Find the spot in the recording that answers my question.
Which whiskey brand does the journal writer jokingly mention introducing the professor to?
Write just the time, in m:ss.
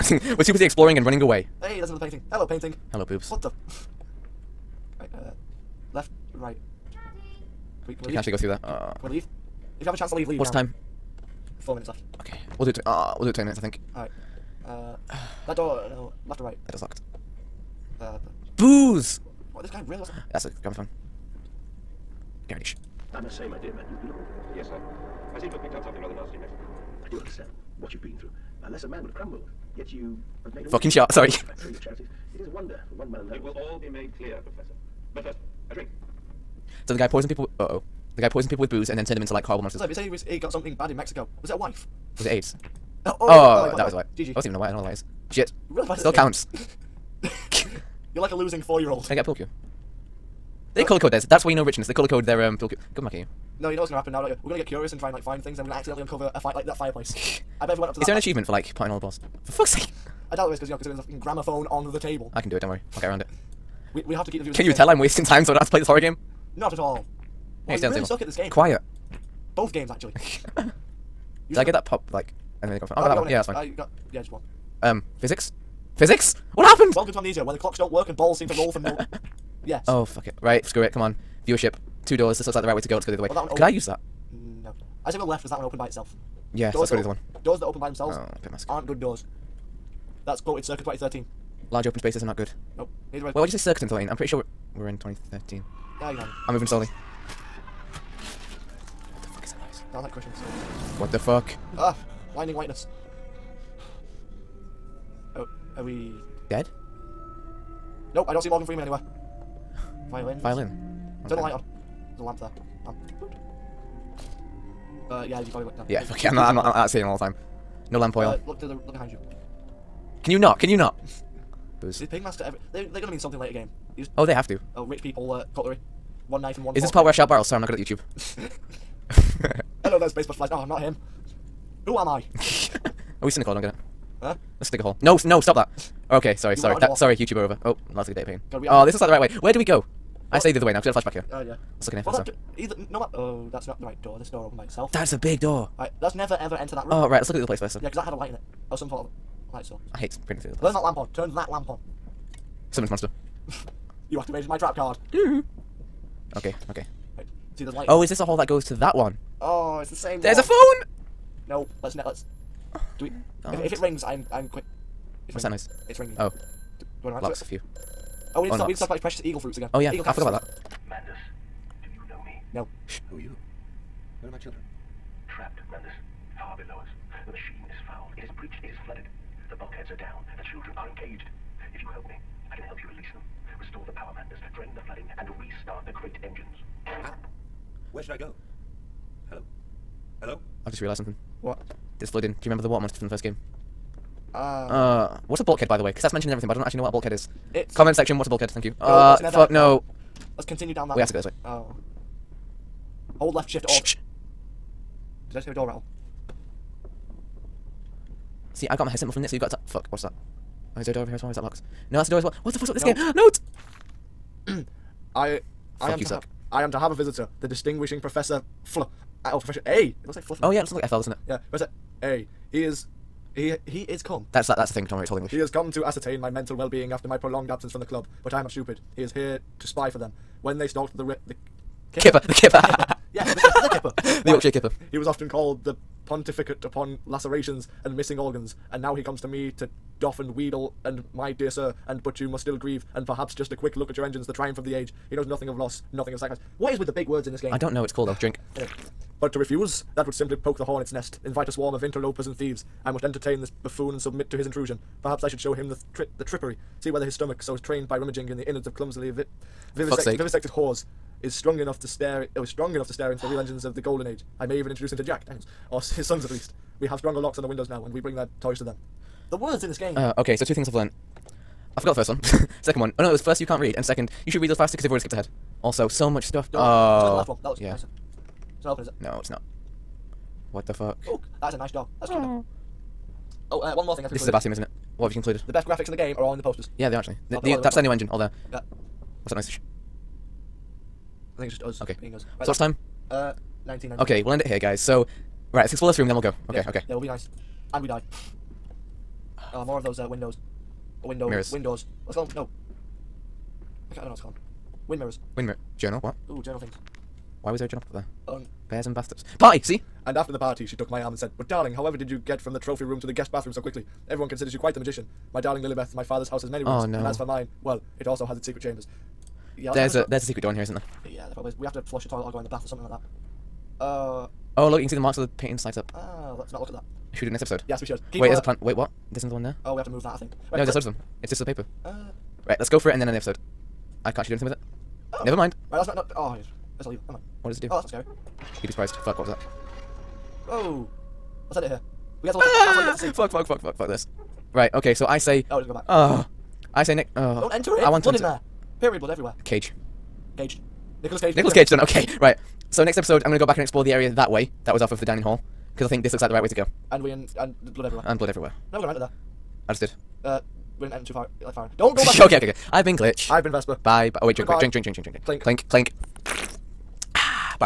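4:25.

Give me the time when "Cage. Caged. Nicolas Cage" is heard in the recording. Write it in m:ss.
5:49.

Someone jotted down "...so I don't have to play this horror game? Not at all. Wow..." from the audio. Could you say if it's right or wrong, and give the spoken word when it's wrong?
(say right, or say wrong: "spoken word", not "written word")
right.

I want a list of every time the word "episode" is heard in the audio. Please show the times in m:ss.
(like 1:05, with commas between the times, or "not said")
5:27, 5:33, 5:52.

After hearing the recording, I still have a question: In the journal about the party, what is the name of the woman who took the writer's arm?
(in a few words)
Lillibeth.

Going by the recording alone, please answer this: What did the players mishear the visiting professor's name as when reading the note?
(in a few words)
Fluff.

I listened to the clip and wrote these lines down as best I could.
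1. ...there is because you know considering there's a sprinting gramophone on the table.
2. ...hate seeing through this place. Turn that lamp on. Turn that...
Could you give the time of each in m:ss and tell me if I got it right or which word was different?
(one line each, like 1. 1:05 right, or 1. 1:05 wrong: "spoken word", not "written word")
1. 1:00 wrong: "fucking", not "sprinting"
2. 2:29 wrong: "sprinting", not "seeing".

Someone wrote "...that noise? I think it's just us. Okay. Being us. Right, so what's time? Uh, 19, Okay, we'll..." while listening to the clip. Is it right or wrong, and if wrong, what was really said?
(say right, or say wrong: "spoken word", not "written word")
right.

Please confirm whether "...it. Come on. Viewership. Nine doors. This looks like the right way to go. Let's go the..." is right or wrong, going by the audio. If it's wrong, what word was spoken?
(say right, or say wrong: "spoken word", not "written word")
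wrong: "Two", not "Nine".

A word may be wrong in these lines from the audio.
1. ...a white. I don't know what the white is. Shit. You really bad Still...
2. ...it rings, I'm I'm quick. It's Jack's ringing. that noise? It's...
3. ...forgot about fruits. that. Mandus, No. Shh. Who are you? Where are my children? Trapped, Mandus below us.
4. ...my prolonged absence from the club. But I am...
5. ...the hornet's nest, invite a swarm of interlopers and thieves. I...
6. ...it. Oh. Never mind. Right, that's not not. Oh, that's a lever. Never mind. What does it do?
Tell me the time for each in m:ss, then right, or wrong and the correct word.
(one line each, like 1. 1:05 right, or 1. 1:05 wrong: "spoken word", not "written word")
1. 0:44 right
2. 2:43 wrong: "What", not "Jack"
3. 2:50 right
4. 3:47 right
5. 4:10 right
6. 5:34 right.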